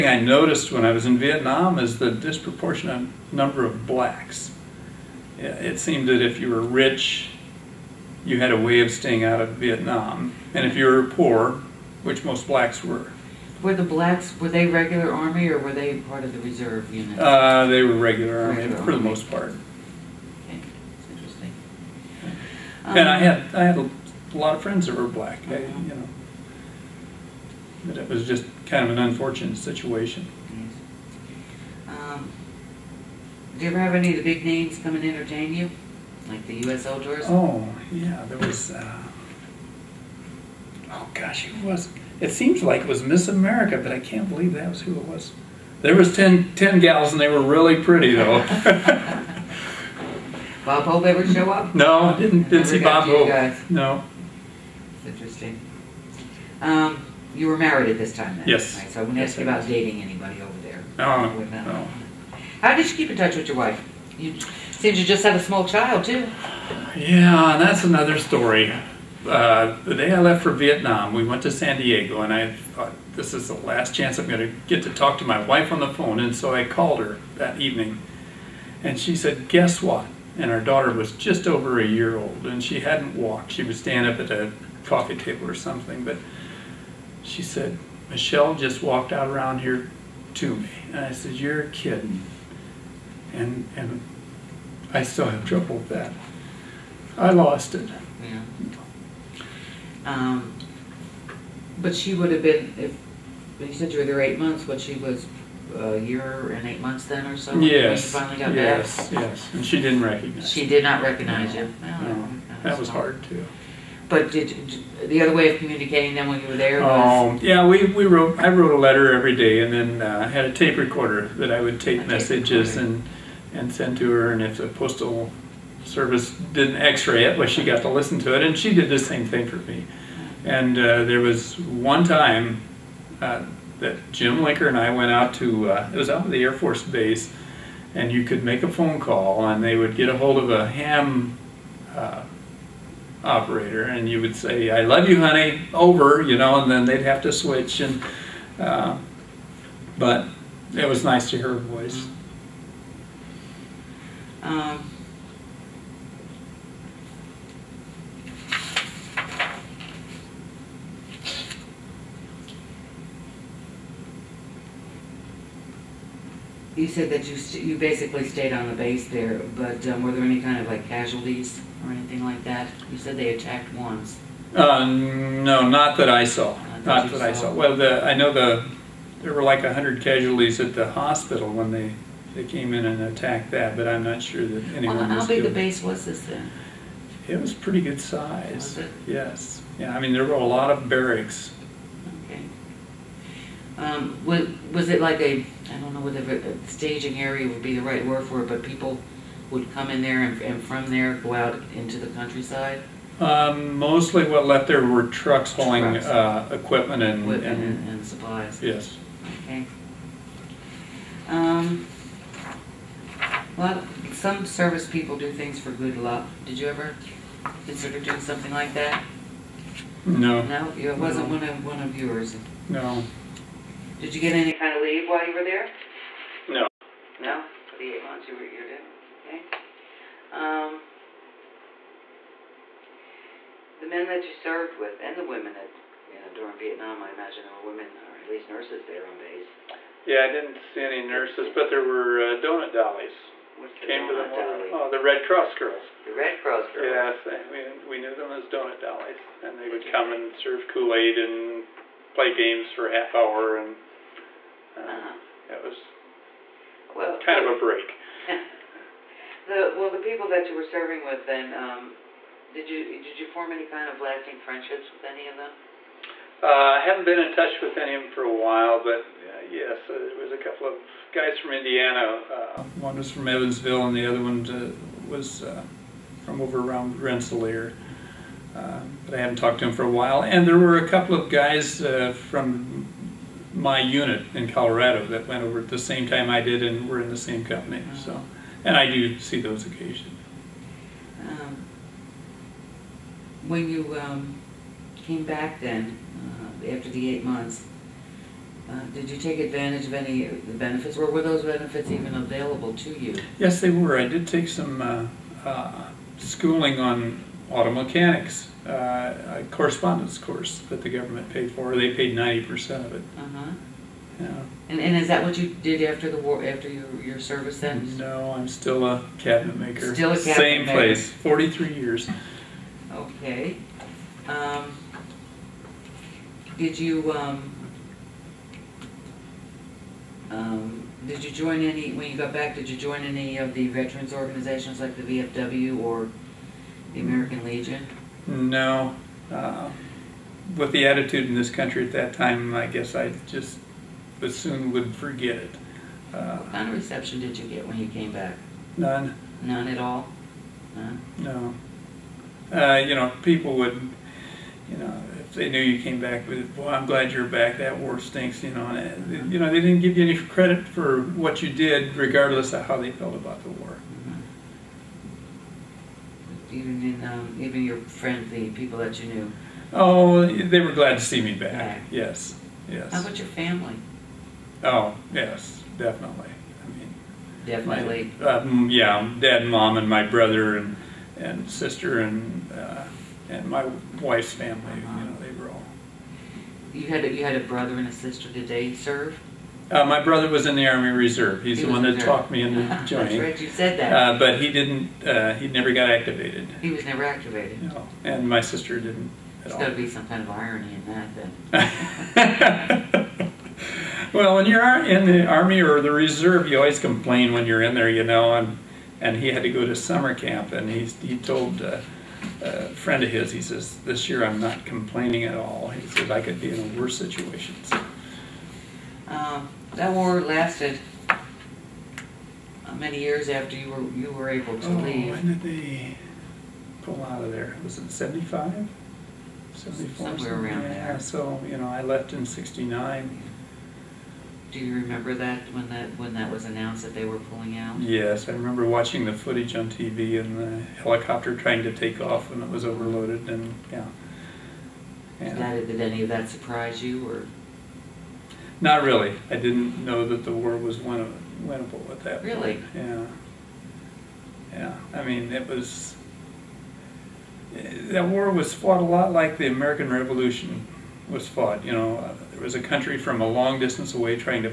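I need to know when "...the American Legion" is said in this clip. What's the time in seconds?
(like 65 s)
336 s.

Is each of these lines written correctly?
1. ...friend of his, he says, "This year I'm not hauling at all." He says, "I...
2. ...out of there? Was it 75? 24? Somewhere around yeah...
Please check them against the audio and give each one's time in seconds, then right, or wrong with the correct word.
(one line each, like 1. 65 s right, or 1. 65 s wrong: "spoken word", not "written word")
1. 412 s wrong: "complaining", not "hauling"
2. 427 s wrong: "74", not "24".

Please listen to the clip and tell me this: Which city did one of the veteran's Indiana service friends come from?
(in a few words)
Evansville.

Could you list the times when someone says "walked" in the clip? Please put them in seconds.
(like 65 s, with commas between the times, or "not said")
83 s, 88 s.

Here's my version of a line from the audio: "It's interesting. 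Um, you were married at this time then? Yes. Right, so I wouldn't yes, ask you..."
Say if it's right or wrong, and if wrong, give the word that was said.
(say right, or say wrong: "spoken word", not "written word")
right.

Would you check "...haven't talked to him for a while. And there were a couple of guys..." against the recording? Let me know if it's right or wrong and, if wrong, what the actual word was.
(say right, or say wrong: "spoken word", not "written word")
right.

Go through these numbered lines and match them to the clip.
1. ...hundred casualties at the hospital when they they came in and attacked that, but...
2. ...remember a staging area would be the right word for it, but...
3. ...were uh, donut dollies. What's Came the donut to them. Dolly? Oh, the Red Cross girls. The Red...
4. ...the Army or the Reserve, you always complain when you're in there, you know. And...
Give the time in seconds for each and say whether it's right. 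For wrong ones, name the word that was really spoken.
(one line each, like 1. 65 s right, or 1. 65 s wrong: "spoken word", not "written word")
1. 179 s right
2. 196 s wrong: "whether", not "remember"
3. 241 s right
4. 405 s right.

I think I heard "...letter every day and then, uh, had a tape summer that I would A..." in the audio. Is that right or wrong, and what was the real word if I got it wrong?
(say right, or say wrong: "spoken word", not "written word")
wrong: "recorder", not "summer".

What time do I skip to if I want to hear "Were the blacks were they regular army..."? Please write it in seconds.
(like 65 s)
13 s.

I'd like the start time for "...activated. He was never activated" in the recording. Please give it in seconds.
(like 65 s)
395 s.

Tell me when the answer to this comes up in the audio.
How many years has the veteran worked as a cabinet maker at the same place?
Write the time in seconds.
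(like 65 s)
321 s.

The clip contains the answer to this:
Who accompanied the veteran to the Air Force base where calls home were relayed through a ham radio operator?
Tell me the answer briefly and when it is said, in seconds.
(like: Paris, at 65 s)
Jim Linker, at 134 s.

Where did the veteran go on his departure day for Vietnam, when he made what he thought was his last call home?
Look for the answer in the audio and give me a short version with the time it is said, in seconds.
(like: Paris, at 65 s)
San Diego, at 71 s.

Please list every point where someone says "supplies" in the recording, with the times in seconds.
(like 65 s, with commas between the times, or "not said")
208 s.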